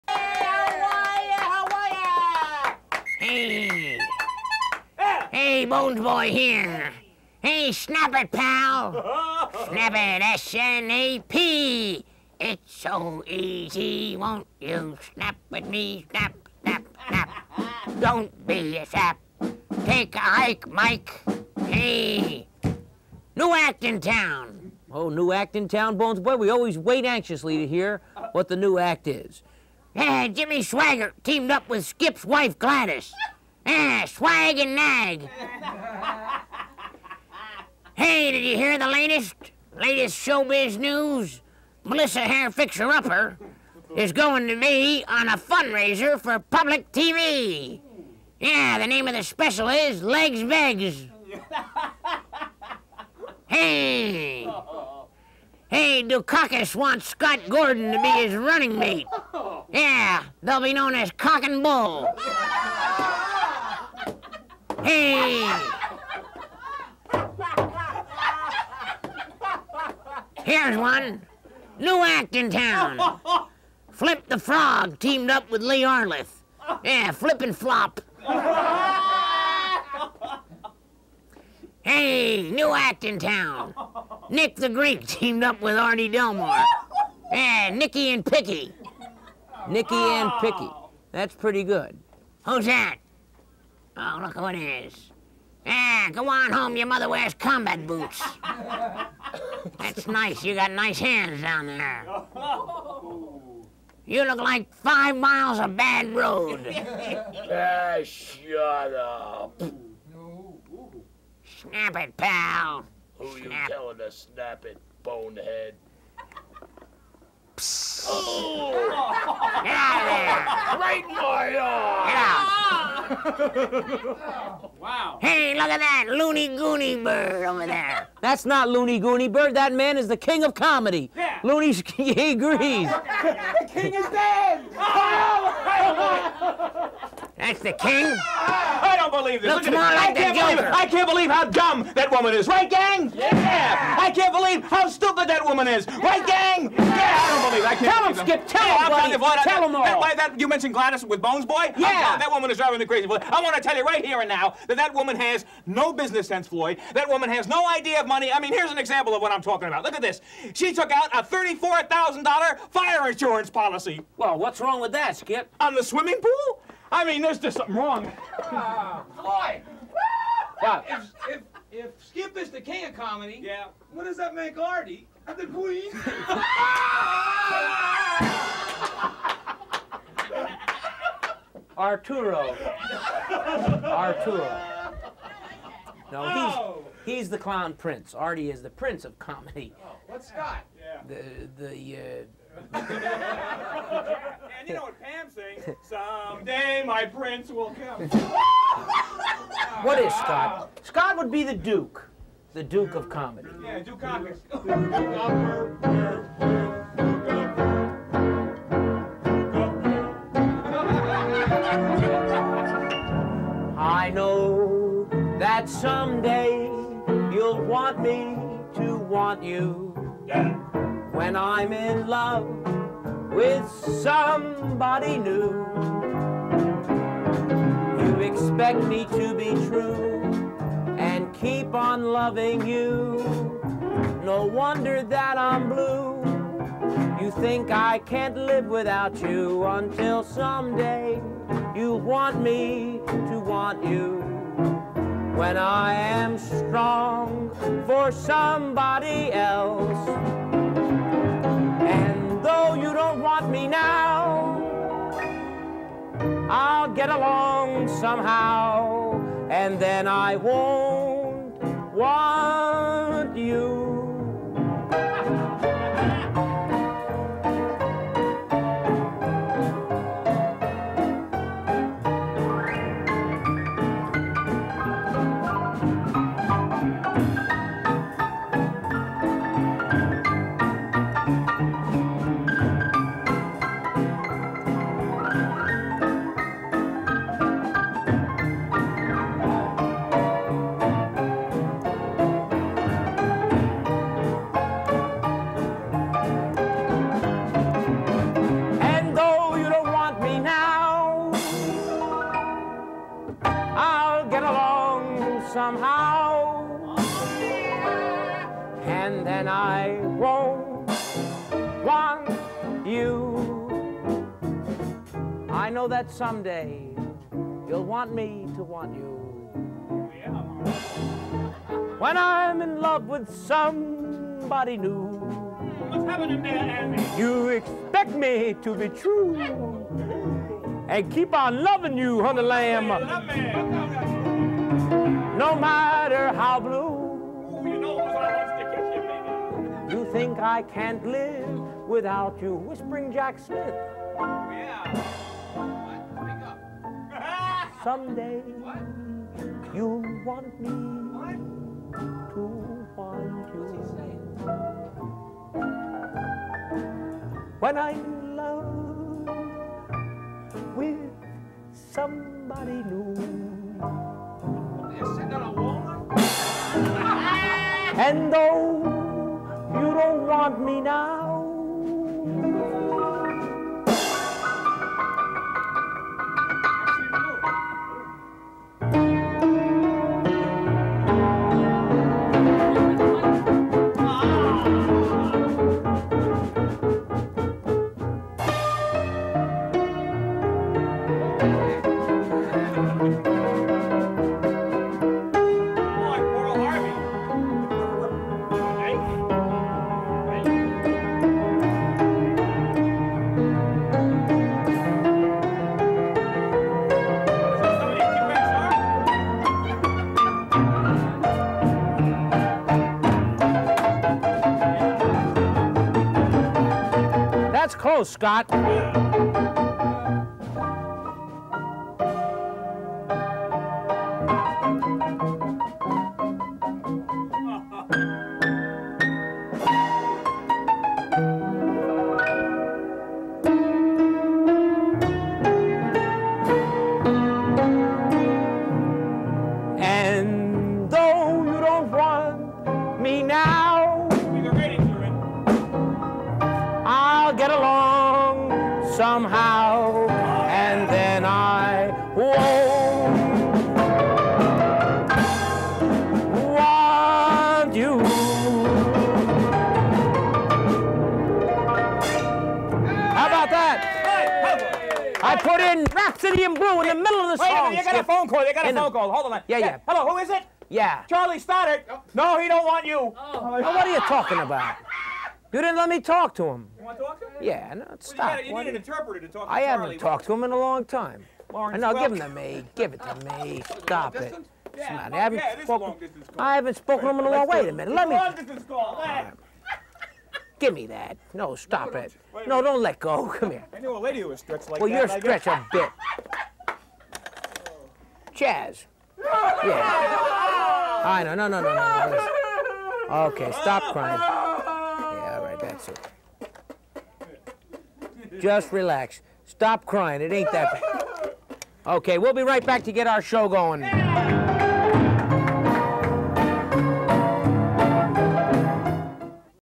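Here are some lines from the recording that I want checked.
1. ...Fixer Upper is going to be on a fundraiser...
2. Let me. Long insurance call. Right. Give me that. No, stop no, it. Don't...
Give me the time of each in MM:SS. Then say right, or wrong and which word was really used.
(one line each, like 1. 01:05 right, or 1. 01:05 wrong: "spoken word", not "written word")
1. 00:42 right
2. 08:07 wrong: "distance", not "insurance".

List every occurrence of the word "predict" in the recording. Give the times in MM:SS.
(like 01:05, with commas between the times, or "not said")
not said.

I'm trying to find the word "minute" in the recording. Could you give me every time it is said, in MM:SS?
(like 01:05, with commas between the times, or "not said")
07:47, 08:07.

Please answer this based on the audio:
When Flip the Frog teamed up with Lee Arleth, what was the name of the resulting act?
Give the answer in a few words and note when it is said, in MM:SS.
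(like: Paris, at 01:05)
Flip and Flop, at 01:17.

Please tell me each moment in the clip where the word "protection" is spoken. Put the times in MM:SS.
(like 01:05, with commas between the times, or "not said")
not said.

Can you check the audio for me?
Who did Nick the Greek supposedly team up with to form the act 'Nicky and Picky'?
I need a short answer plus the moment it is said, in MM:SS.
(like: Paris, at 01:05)
Artie Delmore, at 01:25.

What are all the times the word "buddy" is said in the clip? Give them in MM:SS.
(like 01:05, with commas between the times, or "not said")
02:29.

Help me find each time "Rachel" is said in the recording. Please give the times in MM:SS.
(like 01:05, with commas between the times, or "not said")
not said.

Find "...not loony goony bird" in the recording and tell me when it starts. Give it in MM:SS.
02:08.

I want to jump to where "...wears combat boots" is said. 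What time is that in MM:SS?
01:37.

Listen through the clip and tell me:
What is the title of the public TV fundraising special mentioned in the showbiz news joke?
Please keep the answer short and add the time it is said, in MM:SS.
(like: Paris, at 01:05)
Legs Vegs, at 00:50.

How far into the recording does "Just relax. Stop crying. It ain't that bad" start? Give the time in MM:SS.
08:28.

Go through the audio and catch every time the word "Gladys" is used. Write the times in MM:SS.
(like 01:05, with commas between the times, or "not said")
00:32, 02:30.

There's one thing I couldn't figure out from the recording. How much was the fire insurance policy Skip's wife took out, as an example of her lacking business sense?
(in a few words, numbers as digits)
$34,000.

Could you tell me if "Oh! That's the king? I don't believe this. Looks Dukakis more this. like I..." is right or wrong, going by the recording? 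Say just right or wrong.
wrong.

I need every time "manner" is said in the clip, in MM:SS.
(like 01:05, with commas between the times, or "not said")
not said.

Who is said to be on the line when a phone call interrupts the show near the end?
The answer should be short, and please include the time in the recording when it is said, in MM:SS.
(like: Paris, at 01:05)
Charlie Stoddard, at 07:51.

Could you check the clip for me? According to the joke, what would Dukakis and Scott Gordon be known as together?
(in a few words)
Cock and Bull.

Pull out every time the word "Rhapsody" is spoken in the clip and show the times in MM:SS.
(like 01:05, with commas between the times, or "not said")
07:45.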